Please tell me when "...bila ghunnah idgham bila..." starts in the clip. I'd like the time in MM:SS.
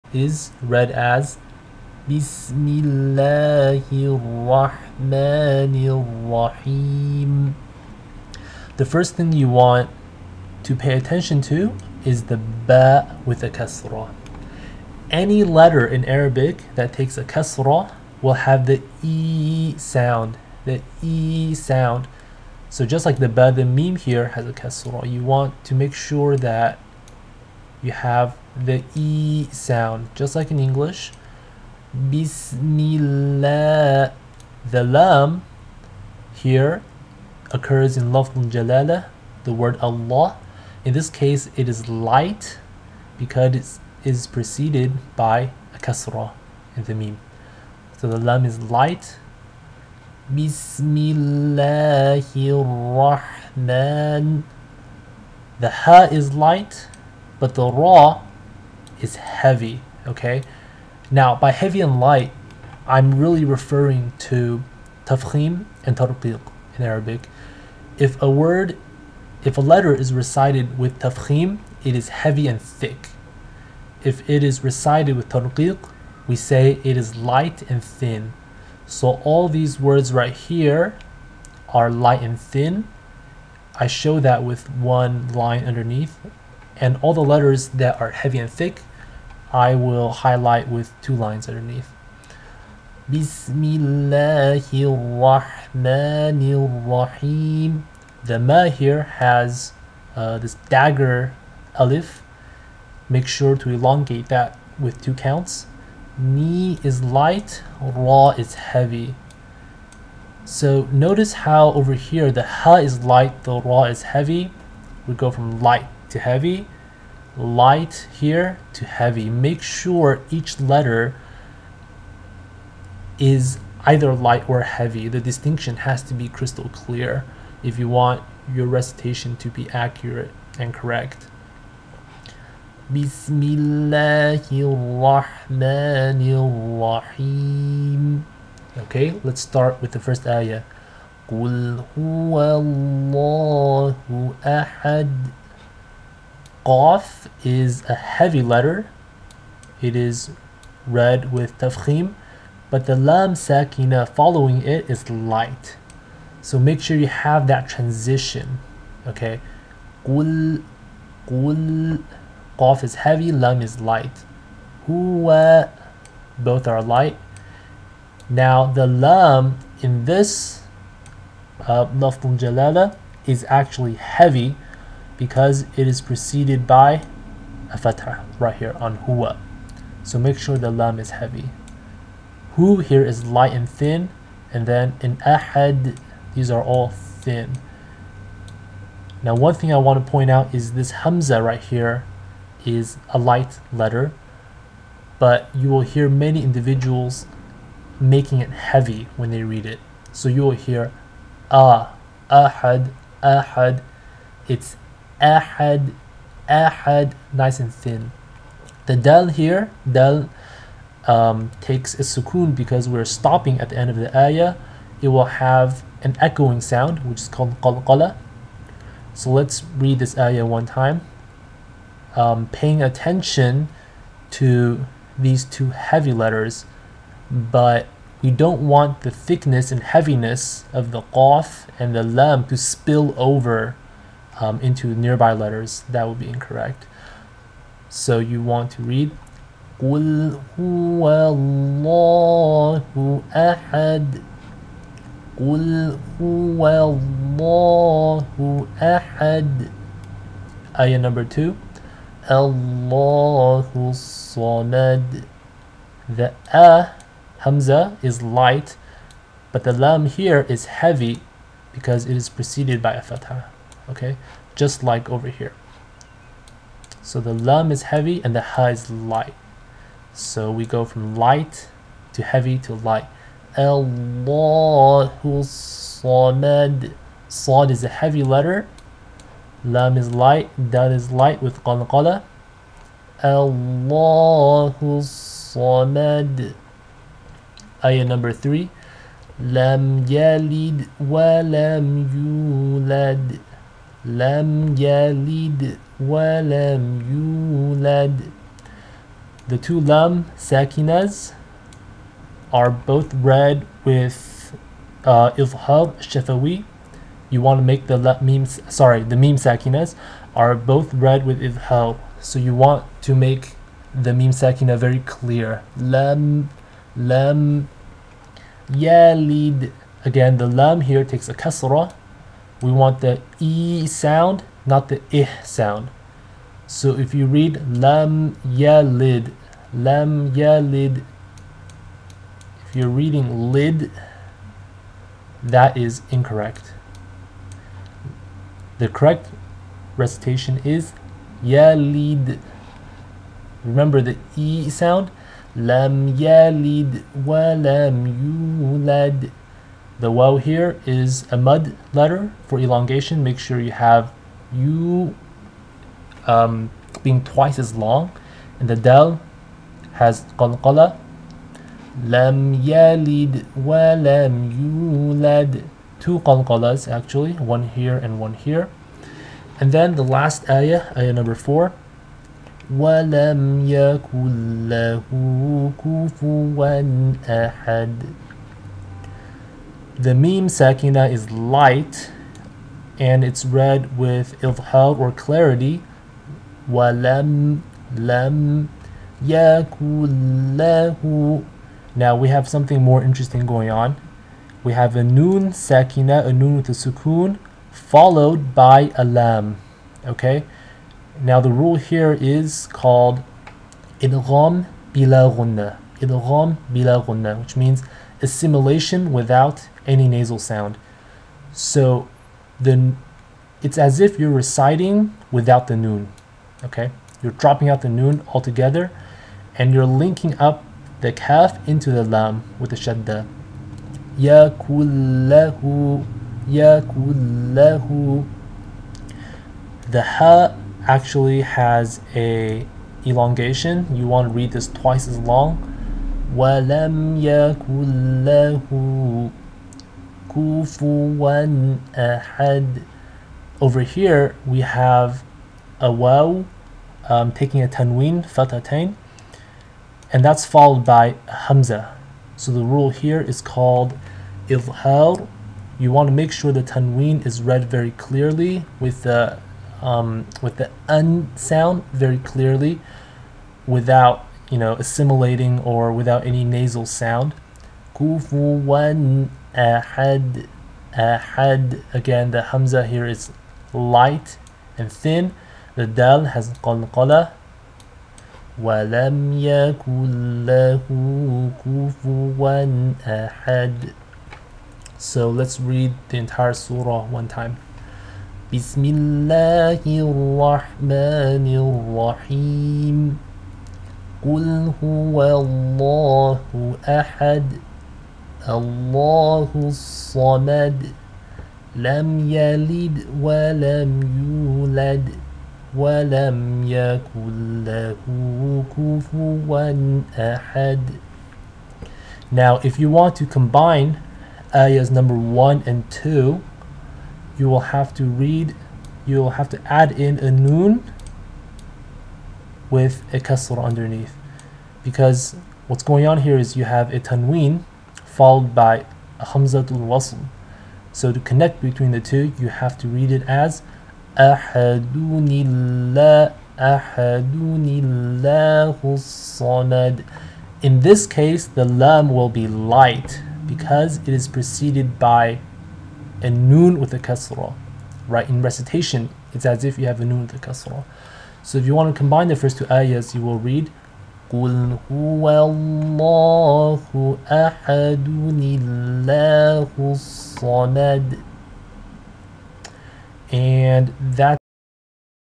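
06:44.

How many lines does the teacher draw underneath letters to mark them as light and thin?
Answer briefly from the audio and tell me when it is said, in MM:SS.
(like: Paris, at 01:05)
1, at 01:24.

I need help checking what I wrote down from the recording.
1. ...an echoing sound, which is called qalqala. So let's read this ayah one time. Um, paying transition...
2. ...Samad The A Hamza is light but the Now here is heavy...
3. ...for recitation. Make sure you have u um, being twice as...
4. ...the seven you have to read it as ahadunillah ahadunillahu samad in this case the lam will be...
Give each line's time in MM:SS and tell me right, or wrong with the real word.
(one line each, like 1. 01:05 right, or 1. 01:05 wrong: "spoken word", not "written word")
1. 03:36 wrong: "attention", not "transition"
2. 04:13 wrong: "Lam", not "Now"
3. 05:52 wrong: "elongation", not "recitation"
4. 08:51 wrong: "two", not "seven".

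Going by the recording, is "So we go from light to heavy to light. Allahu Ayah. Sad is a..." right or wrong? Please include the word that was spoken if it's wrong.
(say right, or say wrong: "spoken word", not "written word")
wrong: "Samad", not "Ayah".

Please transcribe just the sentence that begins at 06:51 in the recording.
So the it's as if you're reciting without the noon.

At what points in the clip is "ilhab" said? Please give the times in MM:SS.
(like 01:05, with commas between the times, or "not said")
05:05, 05:11.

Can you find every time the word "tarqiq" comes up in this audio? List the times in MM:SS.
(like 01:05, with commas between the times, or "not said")
01:05, 01:15.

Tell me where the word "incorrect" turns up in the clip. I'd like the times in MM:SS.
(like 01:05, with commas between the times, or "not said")
03:56, 05:36.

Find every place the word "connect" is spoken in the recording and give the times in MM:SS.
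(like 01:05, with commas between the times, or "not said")
08:51.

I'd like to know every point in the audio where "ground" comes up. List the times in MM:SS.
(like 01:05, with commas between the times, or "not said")
not said.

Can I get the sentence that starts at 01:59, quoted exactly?
Make sure each letter is either light or heavy.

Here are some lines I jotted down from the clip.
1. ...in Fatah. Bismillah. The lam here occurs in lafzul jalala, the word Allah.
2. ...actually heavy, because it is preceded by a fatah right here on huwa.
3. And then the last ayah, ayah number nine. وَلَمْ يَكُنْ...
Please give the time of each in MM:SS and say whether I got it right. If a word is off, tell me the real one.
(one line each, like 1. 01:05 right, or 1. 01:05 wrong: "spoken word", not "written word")
1. 00:30 wrong: "English", not "Fatah"
2. 02:53 right
3. 06:09 wrong: "four", not "nine".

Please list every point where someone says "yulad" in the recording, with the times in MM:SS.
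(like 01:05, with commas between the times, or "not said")
04:52, 05:48, 06:04.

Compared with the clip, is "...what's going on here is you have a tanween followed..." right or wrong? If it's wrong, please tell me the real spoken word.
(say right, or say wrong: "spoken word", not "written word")
right.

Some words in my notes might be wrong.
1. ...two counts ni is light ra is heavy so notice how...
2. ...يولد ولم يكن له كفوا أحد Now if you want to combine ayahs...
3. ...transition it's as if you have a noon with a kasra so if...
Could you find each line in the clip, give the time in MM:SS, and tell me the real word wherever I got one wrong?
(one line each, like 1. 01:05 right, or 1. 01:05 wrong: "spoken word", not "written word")
1. 01:45 right
2. 08:24 right
3. 09:08 wrong: "recitation", not "transition".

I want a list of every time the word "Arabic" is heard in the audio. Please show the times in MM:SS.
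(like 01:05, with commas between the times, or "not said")
00:16, 01:06.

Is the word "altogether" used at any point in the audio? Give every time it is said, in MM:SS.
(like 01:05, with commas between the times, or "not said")
06:58.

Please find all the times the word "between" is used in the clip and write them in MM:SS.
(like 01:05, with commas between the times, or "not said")
08:51.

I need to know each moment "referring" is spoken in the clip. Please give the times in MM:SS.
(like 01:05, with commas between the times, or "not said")
01:03.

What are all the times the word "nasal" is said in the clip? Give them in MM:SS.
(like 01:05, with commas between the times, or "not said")
06:50, 07:46.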